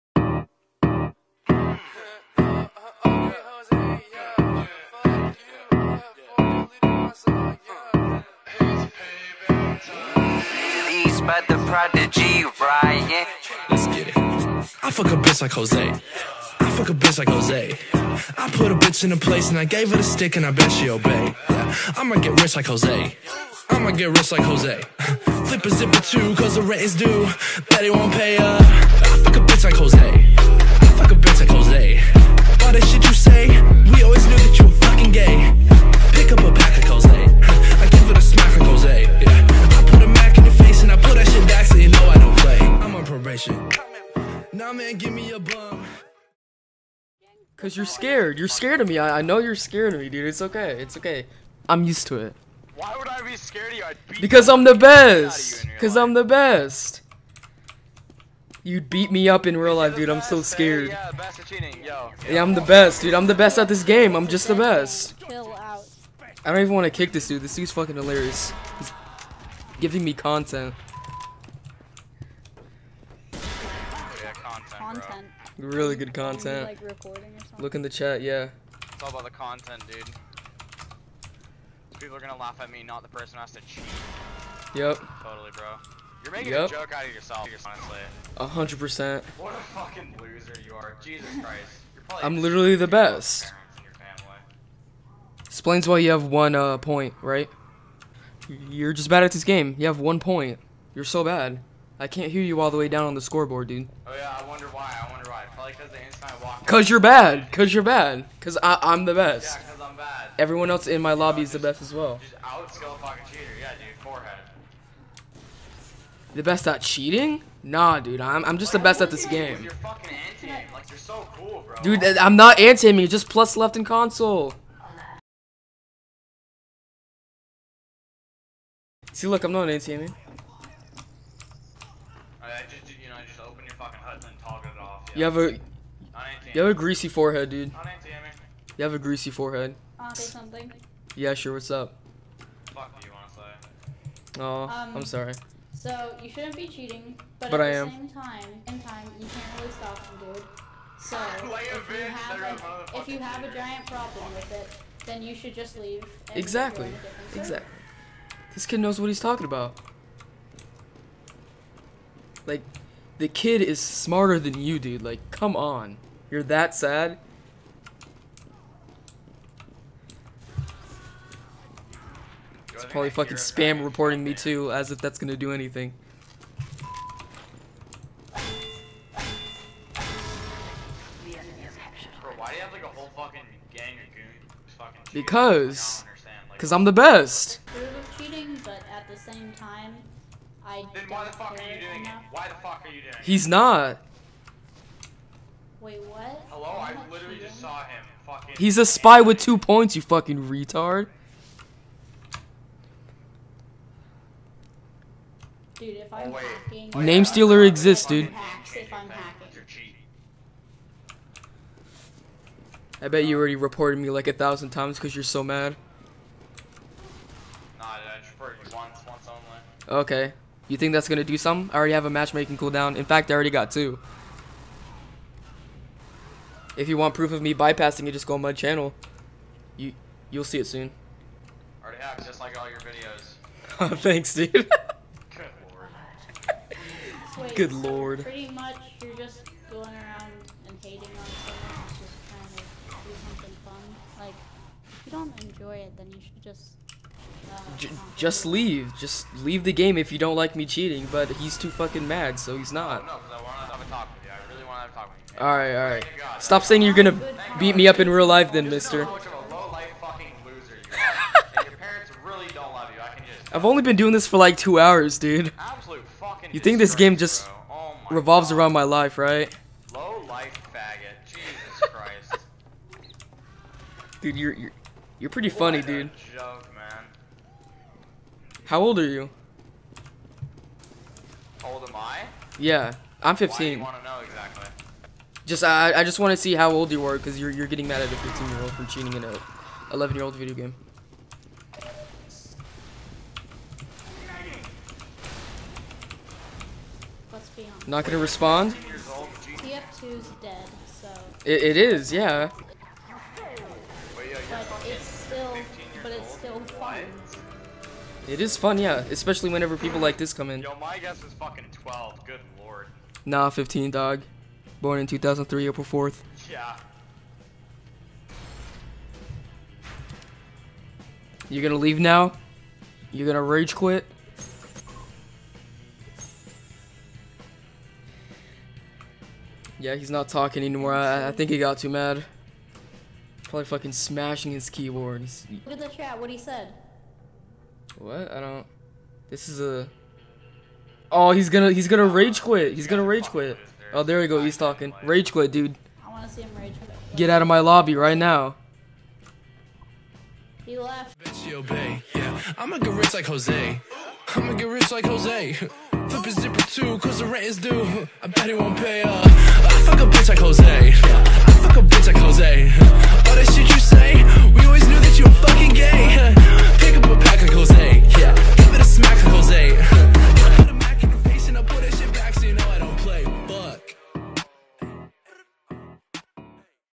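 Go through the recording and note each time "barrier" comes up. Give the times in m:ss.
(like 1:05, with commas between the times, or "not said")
not said.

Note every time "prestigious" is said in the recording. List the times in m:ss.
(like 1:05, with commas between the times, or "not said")
not said.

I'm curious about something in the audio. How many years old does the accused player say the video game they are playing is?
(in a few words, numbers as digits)
11.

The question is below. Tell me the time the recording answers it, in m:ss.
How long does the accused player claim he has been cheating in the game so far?
4:24.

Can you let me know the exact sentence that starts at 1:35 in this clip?
Explains why you have one uh, point, right?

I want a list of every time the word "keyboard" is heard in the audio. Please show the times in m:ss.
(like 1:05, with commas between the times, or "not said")
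5:34.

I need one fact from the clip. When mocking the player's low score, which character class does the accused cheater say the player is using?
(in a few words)
Spy.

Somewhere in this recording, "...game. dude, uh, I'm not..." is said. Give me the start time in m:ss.
1:59.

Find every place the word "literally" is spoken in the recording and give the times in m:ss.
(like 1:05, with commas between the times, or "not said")
1:32, 3:17.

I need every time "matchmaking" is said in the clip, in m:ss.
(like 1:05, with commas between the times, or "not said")
3:42.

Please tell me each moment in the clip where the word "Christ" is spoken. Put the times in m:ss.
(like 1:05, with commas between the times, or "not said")
1:31, 4:31.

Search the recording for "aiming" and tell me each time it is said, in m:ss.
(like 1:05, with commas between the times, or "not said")
2:02, 2:09.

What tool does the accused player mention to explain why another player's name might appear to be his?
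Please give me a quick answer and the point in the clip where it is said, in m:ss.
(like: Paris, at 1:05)
Name stealer, at 3:27.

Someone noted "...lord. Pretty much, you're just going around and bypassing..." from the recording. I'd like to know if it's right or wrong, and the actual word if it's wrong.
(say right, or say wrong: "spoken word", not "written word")
wrong: "hating", not "bypassing".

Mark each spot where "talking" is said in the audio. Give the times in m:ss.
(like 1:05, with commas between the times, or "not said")
2:39, 5:30, 5:44.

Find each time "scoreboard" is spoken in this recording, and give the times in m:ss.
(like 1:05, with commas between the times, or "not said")
1:43.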